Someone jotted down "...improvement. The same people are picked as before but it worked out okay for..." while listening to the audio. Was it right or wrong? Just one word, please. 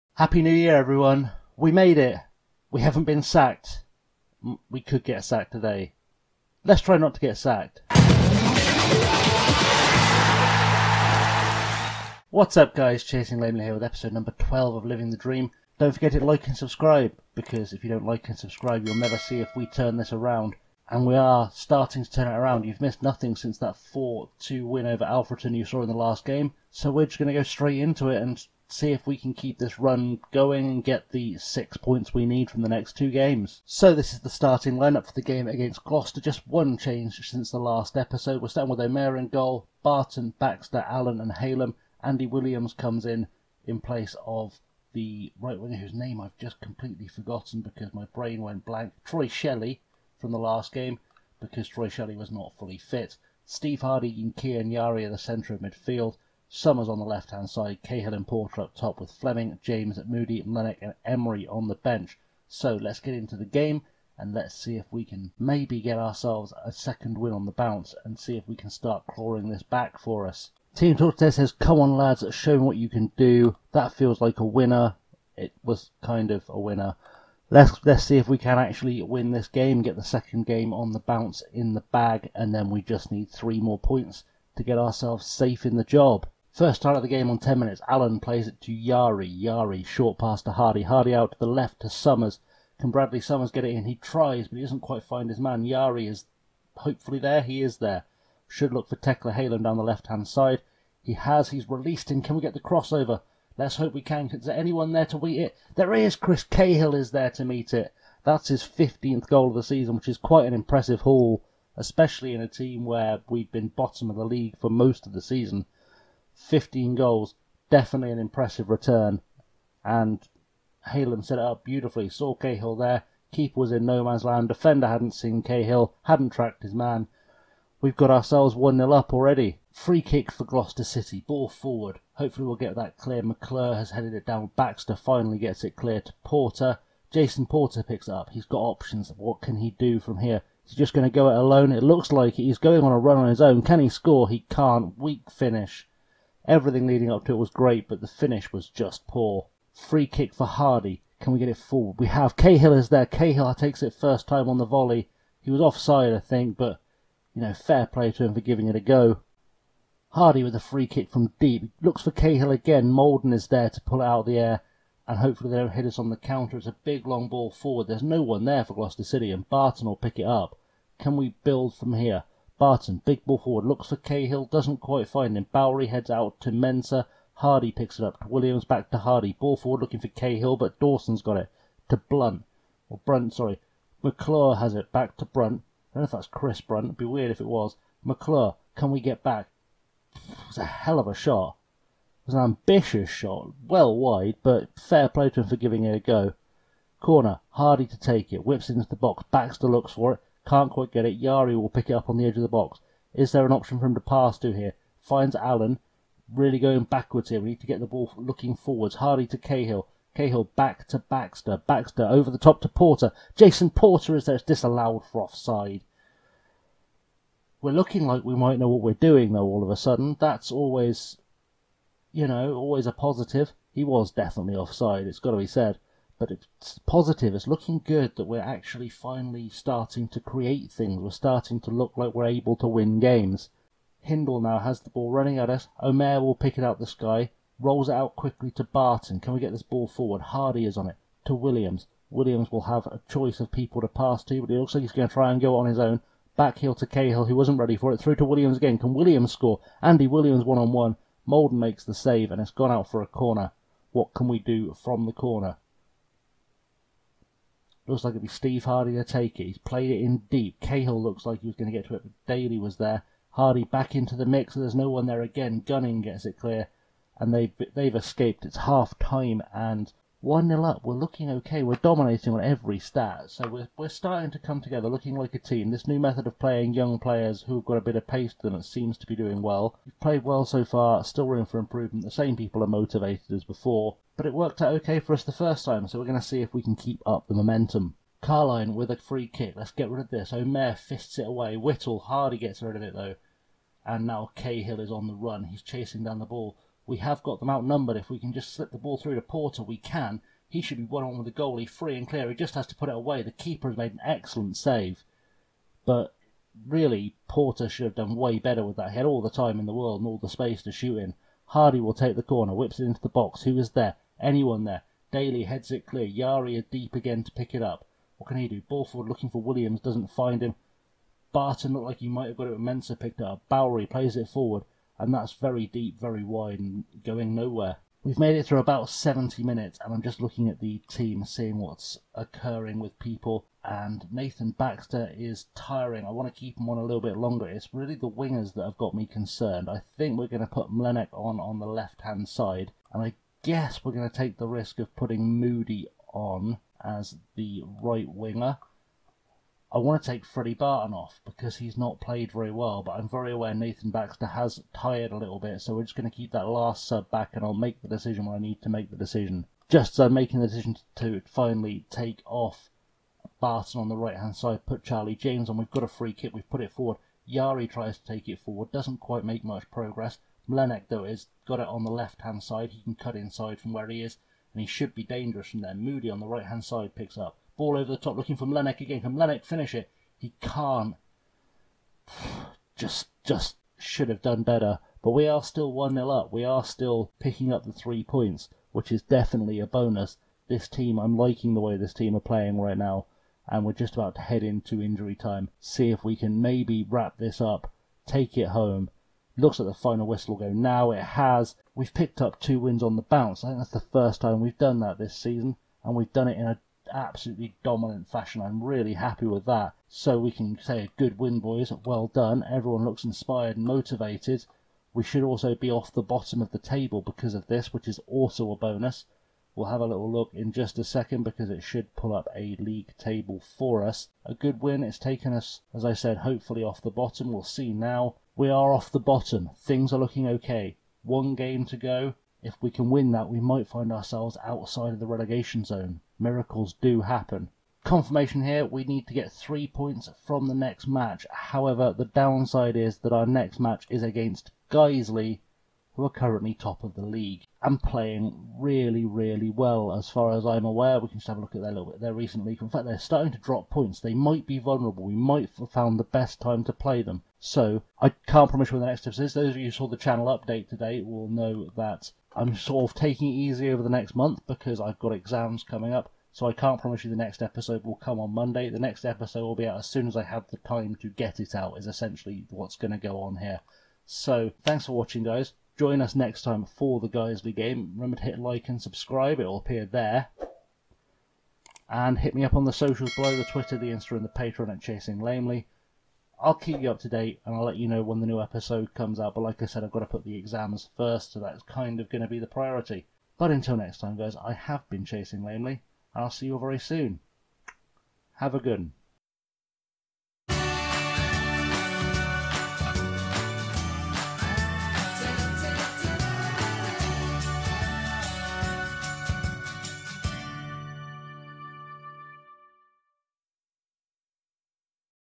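wrong.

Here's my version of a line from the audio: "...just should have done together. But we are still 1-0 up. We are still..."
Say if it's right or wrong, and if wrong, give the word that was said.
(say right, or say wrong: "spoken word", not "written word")
wrong: "better", not "together".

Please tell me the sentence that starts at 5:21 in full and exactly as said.
Barton looked like he might have got it when Mensah picked it up.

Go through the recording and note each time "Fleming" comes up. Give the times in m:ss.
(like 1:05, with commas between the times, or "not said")
0:59.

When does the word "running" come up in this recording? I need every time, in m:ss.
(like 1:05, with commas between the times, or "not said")
3:55.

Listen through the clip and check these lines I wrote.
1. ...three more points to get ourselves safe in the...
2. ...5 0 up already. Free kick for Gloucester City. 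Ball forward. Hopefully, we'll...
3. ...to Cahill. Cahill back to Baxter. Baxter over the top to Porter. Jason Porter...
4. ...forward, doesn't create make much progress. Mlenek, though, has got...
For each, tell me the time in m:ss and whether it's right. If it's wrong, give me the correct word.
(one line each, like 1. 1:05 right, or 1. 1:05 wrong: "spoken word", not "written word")
1. 1:23 right
2. 2:08 wrong: "1", not "5"
3. 3:29 right
4. 6:08 wrong: "quite", not "create".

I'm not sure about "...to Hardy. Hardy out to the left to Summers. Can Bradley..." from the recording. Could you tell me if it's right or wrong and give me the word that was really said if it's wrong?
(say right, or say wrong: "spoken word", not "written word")
right.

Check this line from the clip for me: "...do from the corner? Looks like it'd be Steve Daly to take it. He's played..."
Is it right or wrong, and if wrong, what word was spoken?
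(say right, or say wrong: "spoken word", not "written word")
wrong: "Hardy", not "Daly".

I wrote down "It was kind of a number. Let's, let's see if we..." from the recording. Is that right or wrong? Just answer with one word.
wrong.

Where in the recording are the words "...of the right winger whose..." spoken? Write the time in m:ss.
0:44.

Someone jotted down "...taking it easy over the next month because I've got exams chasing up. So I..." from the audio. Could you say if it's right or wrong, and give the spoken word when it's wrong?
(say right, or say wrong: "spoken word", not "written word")
wrong: "coming", not "chasing".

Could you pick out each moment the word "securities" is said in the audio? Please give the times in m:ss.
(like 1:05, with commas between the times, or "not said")
not said.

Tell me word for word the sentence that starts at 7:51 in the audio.
Is essentially what's going to go on here.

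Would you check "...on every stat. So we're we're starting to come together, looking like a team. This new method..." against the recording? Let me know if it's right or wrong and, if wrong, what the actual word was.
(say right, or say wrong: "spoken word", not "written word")
right.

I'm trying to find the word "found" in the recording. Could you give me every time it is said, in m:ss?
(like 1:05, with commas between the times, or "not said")
7:35.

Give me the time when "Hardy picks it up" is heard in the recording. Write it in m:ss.
2:57.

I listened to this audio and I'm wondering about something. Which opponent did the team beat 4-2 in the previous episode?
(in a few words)
Alfreton.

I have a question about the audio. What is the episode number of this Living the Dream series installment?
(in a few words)
12.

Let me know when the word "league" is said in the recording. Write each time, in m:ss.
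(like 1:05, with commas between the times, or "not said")
1:54, 7:02, 7:27.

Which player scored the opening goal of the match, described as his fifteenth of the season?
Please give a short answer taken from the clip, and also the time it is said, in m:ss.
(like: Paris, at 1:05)
Chris Cahill, at 1:46.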